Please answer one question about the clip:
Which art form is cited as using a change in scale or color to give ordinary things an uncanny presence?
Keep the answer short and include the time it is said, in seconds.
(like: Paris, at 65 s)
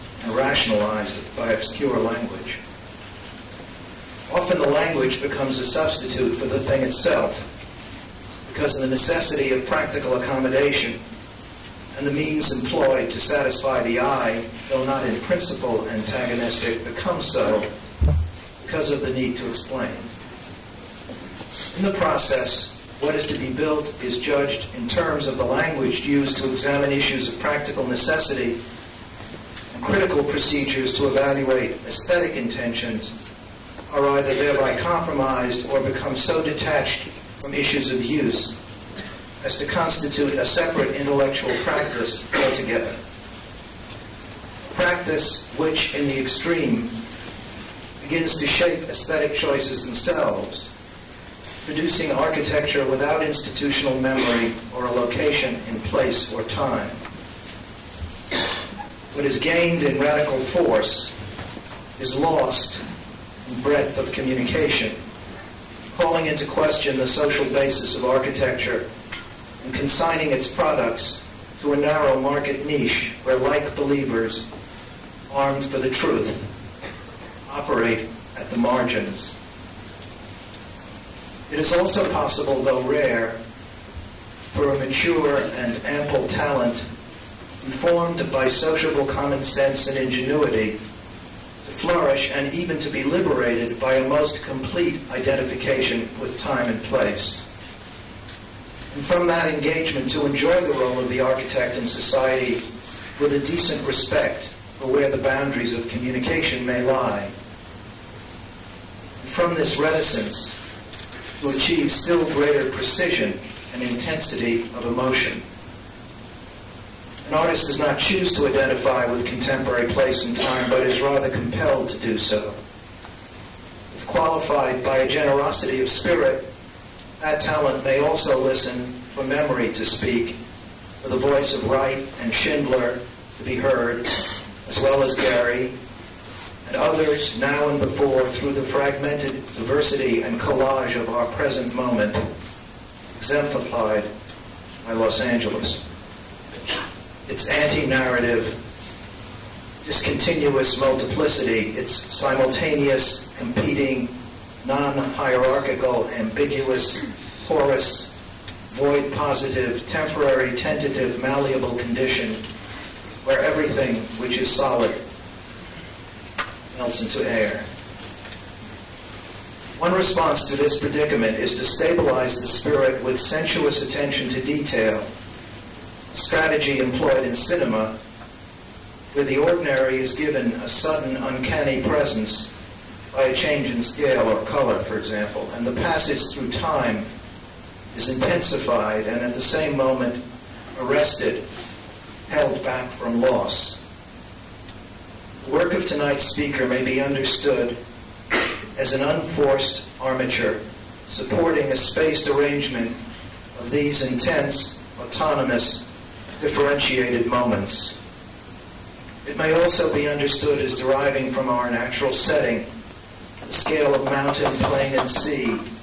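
Cinema, at 177 s.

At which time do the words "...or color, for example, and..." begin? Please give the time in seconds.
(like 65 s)
184 s.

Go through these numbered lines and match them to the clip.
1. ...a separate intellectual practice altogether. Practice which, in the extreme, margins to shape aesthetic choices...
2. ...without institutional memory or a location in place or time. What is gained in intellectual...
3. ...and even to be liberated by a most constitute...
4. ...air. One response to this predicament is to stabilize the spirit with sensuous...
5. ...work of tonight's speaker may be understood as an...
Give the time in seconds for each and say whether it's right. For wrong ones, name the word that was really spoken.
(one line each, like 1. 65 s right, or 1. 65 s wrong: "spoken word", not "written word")
1. 40 s wrong: "begins", not "margins"
2. 52 s wrong: "radical", not "intellectual"
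3. 92 s wrong: "complete", not "constitute"
4. 167 s right
5. 195 s right.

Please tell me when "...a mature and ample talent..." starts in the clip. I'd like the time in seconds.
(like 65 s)
84 s.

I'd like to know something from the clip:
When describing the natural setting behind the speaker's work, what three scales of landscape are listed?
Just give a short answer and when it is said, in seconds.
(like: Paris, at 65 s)
Mountain, plain, and sea, at 214 s.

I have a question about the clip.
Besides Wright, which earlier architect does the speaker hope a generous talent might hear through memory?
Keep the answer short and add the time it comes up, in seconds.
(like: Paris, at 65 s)
Schindler, at 132 s.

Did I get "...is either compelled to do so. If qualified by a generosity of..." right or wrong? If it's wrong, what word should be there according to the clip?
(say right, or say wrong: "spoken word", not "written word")
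wrong: "rather", not "either".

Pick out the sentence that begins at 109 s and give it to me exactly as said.
from this reticence, to achieve still greater precision and intensity of emotion.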